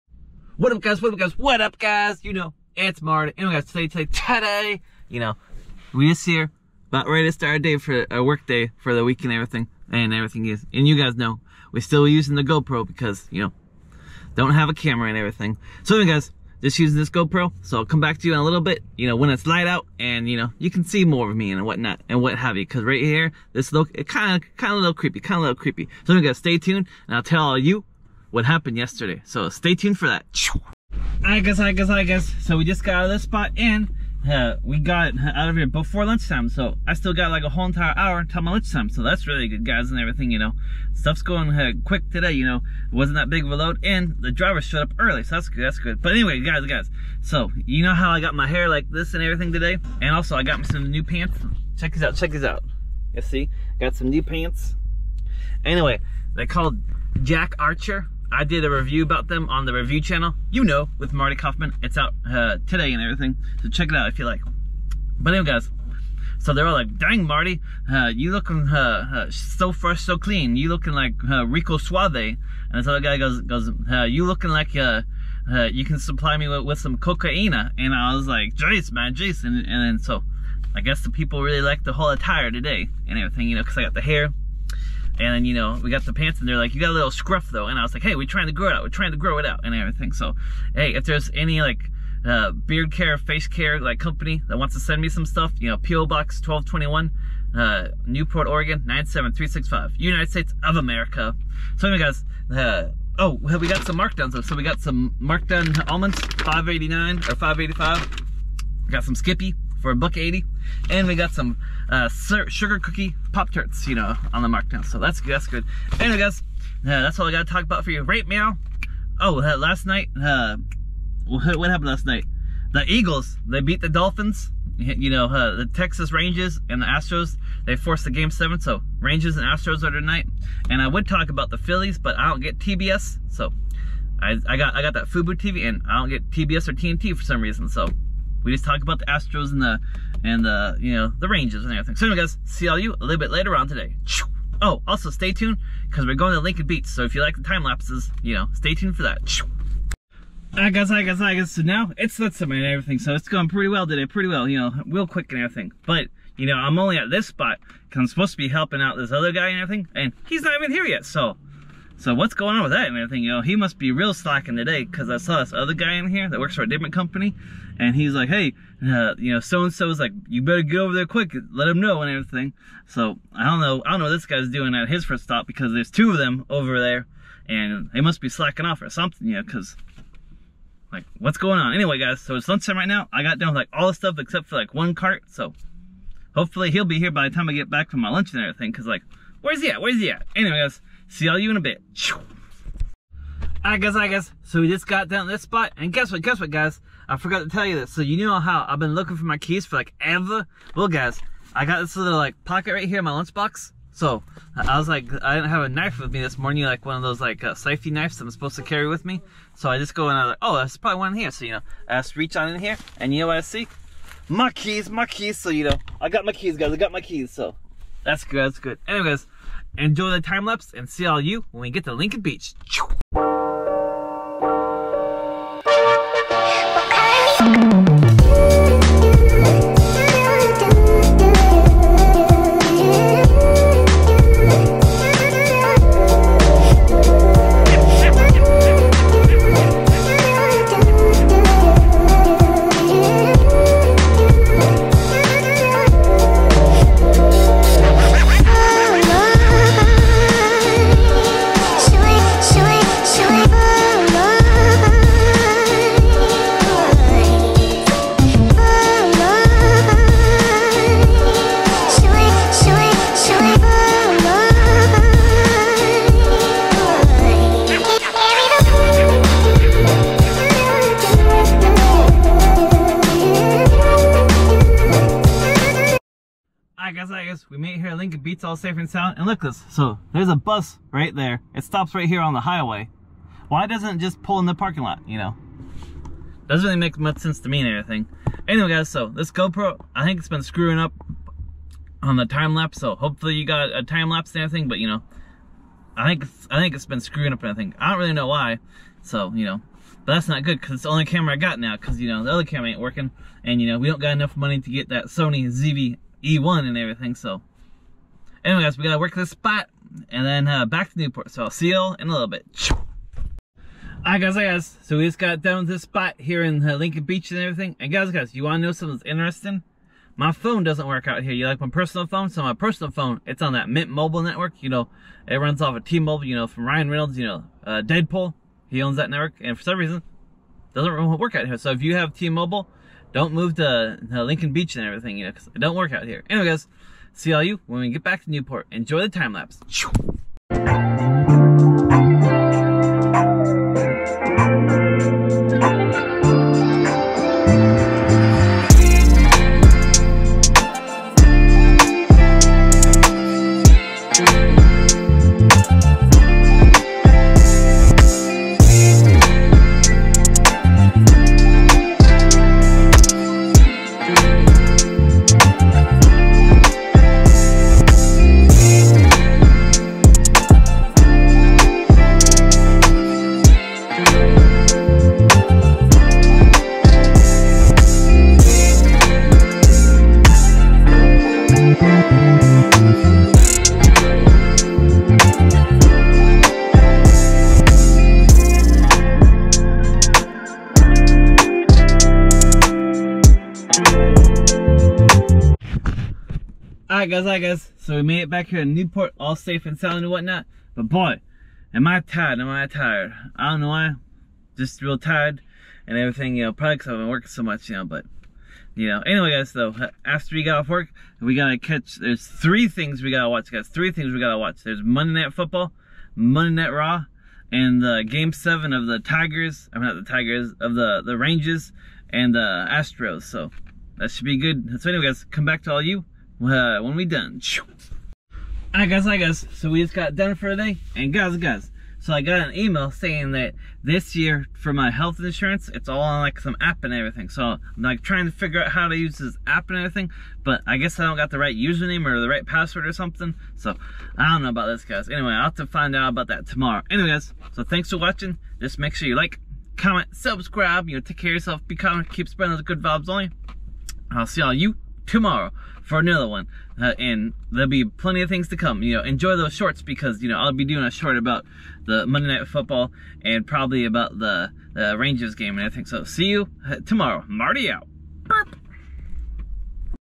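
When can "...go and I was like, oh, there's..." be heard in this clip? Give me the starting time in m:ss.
3:29.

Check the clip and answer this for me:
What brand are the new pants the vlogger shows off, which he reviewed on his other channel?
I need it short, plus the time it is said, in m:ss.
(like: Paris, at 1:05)
Jack Archer, at 0:57.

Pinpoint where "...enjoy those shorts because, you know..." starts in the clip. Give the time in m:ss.
7:39.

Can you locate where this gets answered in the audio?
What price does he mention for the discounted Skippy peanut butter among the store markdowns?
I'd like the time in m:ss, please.
1:49.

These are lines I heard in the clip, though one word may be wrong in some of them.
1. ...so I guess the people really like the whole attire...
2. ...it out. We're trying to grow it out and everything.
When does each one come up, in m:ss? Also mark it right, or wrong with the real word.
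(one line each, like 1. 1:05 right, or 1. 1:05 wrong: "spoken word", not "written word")
1. 1:19 right
2. 1:28 right.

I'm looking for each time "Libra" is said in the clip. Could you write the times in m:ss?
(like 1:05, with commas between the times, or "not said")
not said.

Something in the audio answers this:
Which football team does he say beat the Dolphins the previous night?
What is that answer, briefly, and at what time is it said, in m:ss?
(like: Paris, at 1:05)
Eagles, at 2:02.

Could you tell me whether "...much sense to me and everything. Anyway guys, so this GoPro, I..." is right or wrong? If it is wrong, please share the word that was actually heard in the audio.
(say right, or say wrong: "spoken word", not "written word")
right.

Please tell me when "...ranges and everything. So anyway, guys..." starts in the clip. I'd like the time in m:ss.
2:21.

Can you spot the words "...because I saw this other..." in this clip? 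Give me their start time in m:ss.
2:44.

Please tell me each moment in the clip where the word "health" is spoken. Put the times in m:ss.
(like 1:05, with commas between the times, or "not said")
7:14.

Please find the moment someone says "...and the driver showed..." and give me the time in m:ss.
0:43.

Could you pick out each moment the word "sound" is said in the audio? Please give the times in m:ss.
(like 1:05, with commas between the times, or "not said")
4:38, 6:39.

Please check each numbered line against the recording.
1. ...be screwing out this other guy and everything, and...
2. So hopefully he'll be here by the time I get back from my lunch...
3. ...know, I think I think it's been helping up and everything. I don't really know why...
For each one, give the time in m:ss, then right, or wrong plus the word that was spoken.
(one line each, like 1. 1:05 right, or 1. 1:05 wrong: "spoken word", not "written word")
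1. 2:38 wrong: "helping", not "screwing"
2. 3:05 right
3. 4:54 wrong: "screwing", not "helping".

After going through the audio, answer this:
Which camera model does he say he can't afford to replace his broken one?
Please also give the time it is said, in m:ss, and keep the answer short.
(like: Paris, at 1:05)
Sony ZV E1, at 5:05.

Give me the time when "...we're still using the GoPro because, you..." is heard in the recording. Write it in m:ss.
0:11.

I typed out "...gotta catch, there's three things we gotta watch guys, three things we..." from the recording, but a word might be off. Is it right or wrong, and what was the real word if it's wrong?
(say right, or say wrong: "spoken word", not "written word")
right.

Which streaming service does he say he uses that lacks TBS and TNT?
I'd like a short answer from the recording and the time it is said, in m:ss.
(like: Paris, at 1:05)
Fubo TV, at 2:15.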